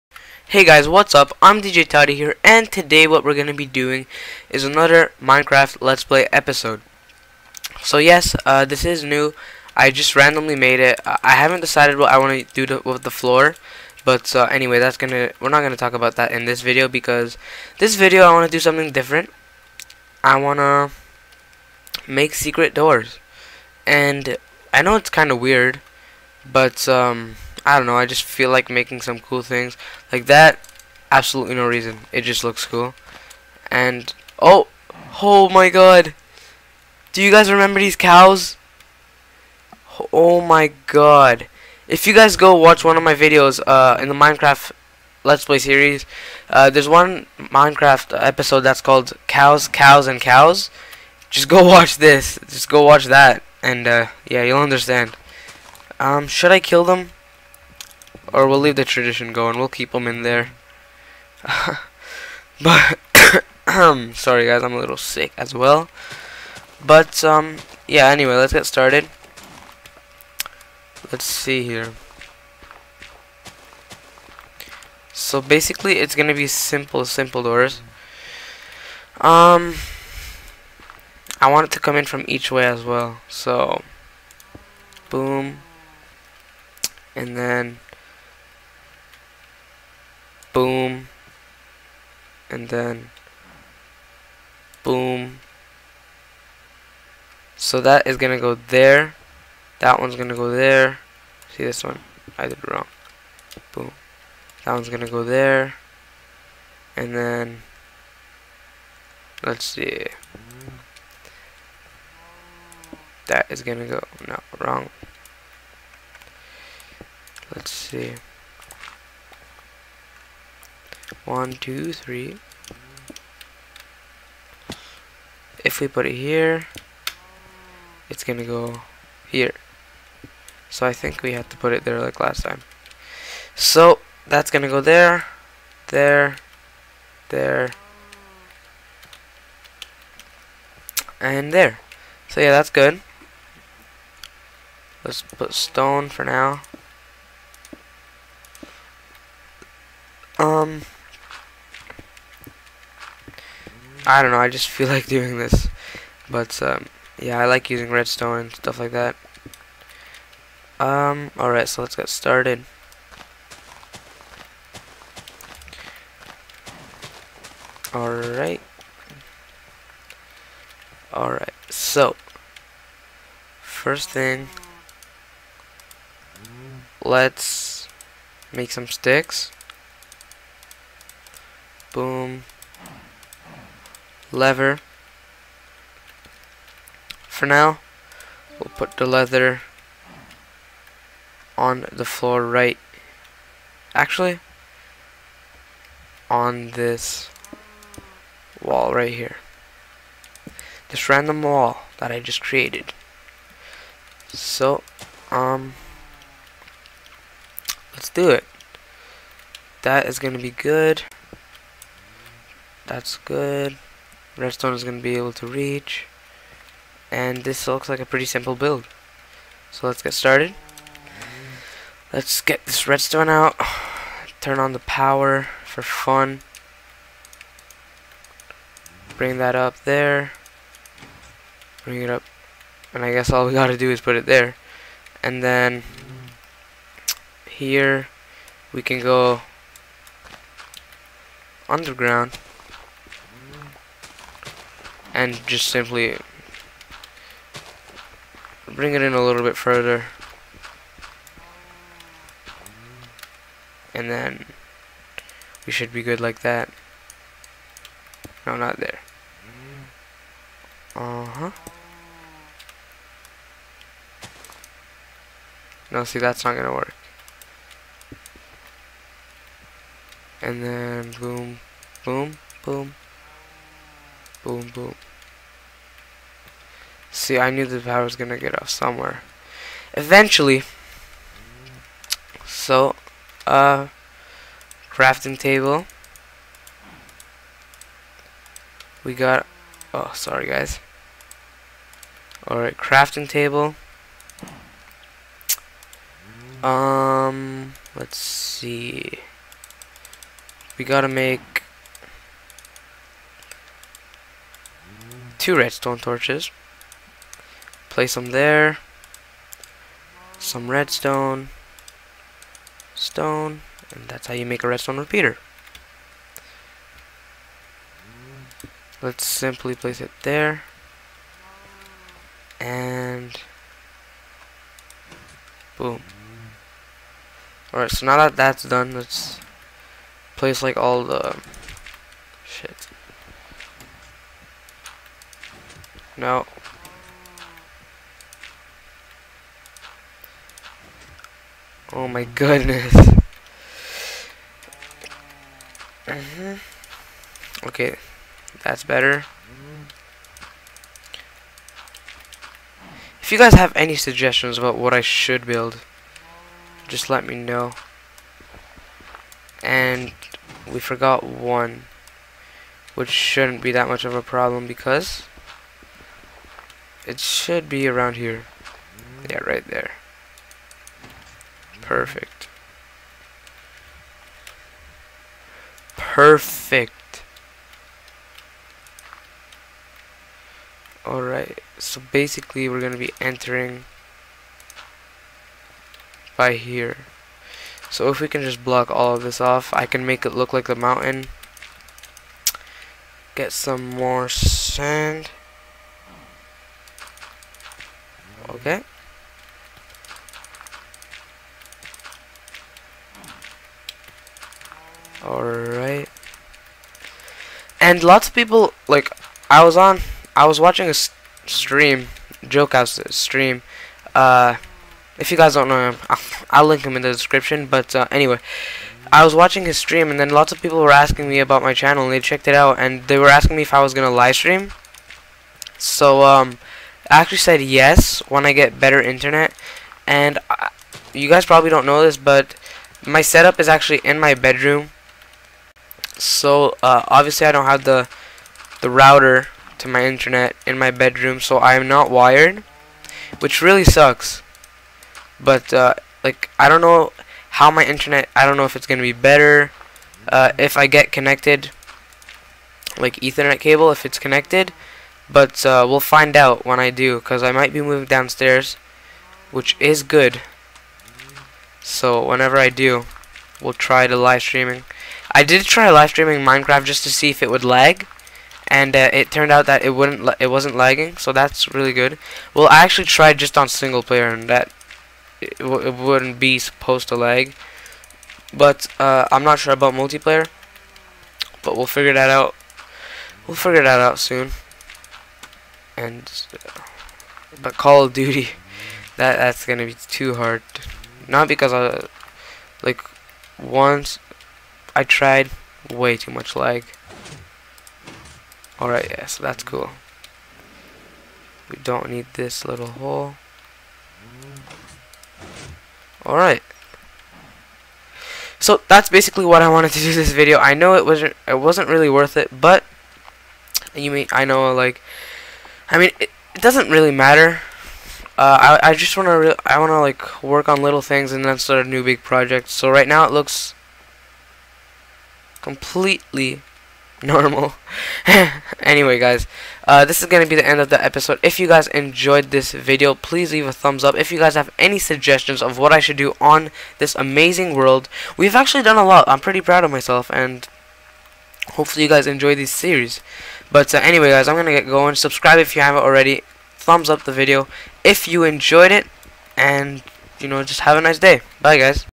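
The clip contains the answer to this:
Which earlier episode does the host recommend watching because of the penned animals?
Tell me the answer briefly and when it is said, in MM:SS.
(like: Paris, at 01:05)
Cows, Cows, and Cows, at 00:49.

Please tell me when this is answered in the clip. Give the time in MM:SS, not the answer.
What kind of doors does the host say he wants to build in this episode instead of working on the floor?
00:22.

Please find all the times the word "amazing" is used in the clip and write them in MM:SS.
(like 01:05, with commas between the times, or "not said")
08:57.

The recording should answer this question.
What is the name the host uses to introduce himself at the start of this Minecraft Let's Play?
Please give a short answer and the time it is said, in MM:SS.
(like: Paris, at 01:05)
DJ Toti, at 00:01.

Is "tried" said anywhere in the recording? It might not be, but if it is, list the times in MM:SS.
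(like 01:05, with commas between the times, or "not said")
07:53, 08:15.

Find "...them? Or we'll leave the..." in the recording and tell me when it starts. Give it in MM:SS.
00:56.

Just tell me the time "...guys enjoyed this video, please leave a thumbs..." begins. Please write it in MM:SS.
08:51.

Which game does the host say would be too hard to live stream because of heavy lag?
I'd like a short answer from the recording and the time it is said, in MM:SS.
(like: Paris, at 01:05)
Call of Duty, at 08:07.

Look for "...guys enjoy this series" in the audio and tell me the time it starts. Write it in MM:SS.
09:02.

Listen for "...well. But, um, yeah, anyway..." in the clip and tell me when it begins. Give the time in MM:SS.
01:05.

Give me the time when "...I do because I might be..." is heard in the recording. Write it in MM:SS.
07:36.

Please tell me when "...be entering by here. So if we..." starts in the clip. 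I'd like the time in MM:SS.
06:22.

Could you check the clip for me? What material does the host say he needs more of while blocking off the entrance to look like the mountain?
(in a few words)
Sand.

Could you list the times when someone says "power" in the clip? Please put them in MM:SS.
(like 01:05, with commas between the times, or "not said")
03:44, 04:37.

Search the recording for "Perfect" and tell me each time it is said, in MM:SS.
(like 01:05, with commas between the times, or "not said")
06:11, 06:15.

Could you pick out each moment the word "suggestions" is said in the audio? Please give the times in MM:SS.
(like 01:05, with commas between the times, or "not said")
05:53, 08:54.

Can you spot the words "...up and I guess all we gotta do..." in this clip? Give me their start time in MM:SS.
03:52.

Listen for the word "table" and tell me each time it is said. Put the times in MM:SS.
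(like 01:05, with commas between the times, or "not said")
04:45, 04:53.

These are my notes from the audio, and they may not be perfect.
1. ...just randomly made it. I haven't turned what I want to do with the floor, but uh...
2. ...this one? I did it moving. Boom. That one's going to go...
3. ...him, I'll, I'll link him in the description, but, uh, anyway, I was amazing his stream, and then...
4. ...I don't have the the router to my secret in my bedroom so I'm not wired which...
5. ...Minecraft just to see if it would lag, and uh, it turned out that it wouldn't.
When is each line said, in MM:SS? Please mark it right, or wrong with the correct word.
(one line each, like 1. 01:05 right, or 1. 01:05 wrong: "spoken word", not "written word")
1. 00:09 wrong: "decided", not "turned"
2. 01:41 wrong: "wrong", not "moving"
3. 06:55 wrong: "watching", not "amazing"
4. 07:17 wrong: "internet", not "secret"
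5. 07:46 right.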